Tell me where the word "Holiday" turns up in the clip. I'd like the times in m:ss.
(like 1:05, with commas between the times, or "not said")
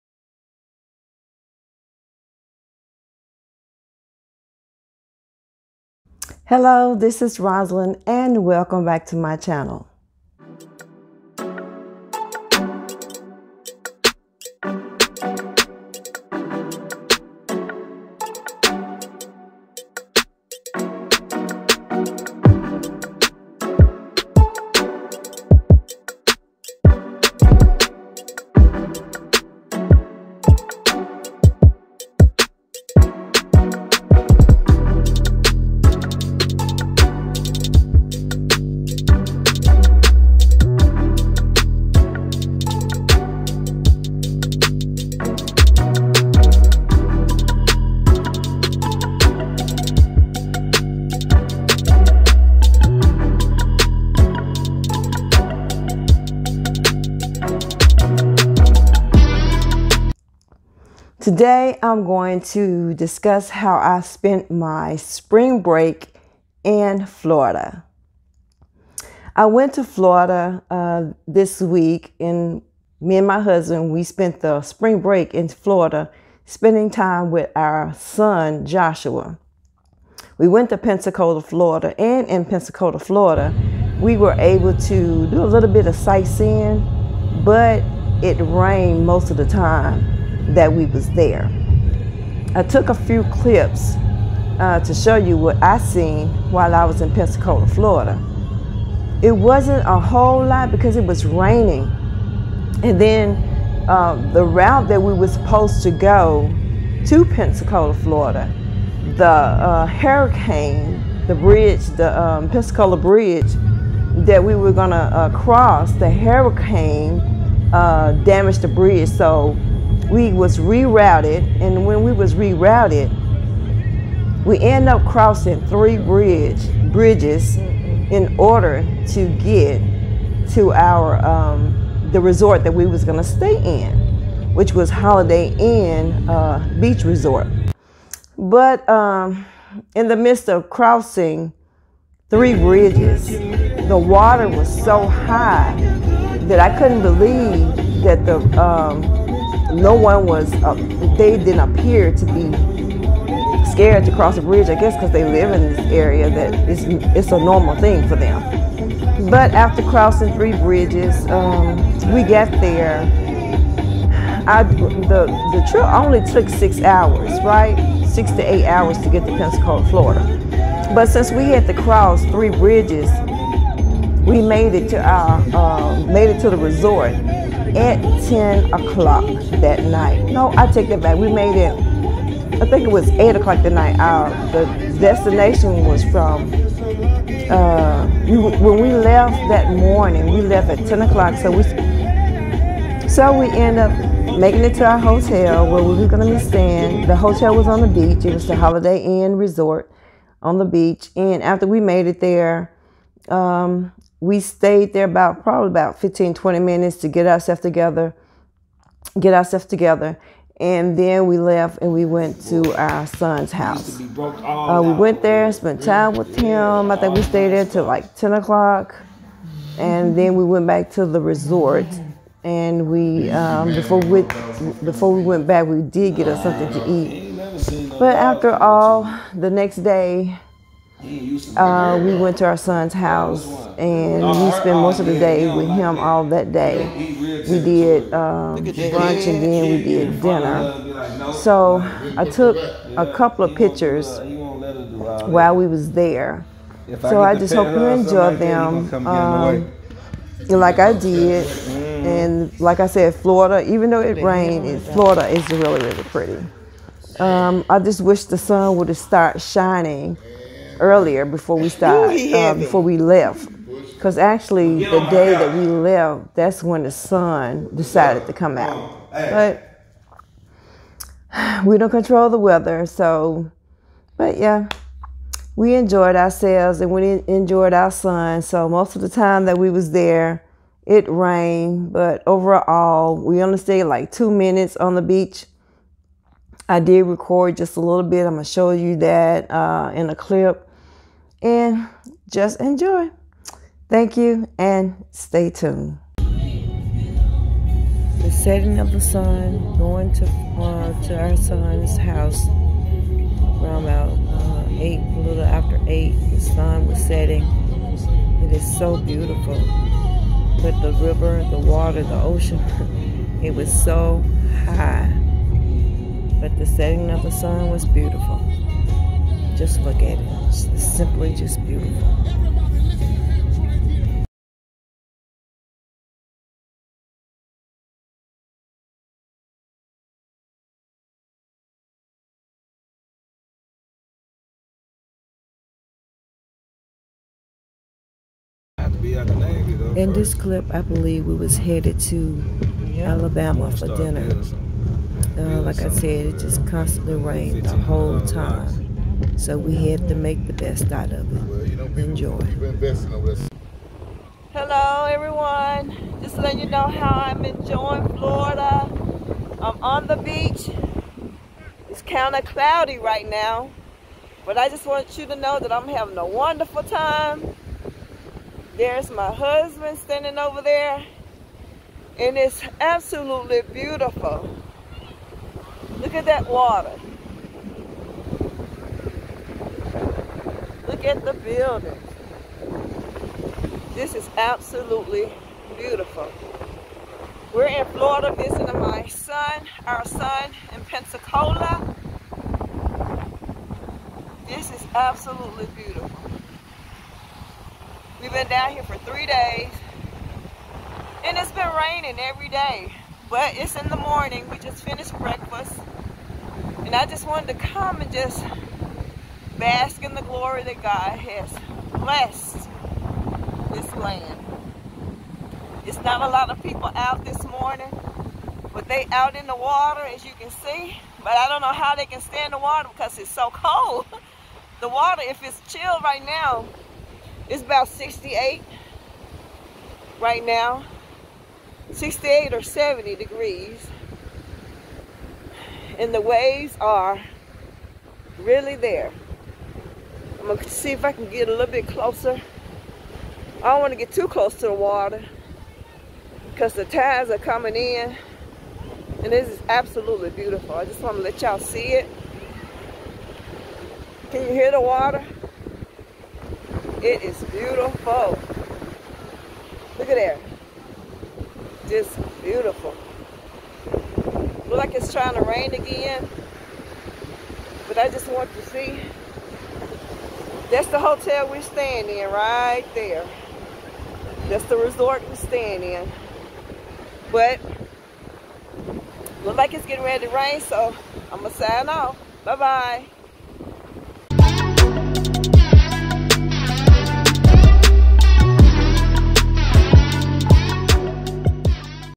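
2:14, 3:18.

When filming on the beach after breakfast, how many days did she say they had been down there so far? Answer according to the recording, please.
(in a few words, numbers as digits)
3.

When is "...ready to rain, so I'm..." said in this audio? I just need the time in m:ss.
8:00.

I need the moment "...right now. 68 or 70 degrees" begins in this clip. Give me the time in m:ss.
7:10.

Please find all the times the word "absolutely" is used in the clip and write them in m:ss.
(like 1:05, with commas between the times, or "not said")
6:12, 6:24, 6:34, 7:29.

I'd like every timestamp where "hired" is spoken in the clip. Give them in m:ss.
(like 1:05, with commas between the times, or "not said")
not said.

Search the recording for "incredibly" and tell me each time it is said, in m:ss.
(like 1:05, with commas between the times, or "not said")
not said.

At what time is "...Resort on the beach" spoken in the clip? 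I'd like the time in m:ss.
3:19.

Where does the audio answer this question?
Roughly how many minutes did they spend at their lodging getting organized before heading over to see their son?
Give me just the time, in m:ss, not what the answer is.
3:25.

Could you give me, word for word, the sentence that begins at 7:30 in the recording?
I just wanna let y'all see it.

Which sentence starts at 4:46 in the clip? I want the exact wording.
I did record just a little bit.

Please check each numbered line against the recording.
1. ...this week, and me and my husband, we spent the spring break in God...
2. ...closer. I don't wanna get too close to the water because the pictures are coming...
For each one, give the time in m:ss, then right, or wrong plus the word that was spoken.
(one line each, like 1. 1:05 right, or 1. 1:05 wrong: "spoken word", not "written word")
1. 1:11 wrong: "Florida", not "God"
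2. 7:21 wrong: "tides", not "pictures".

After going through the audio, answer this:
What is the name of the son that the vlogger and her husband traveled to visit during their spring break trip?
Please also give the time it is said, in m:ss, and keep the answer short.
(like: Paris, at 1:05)
Joshua, at 1:18.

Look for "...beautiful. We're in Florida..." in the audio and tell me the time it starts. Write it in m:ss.
6:25.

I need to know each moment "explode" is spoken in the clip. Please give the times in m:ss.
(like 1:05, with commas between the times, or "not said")
not said.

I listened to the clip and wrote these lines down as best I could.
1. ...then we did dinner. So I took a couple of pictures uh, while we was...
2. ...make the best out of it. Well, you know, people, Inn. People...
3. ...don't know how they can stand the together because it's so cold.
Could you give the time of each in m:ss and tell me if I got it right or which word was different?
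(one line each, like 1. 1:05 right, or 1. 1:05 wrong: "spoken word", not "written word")
1. 3:59 right
2. 5:50 wrong: "Enjoy", not "Inn"
3. 7:01 wrong: "water", not "together".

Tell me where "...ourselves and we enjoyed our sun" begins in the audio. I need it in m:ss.
4:36.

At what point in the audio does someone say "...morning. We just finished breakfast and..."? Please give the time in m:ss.
6:43.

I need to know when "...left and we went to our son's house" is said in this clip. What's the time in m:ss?
3:31.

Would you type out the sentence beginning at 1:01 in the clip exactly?
Today, I'm going to discuss how I spent my spring break in Florida.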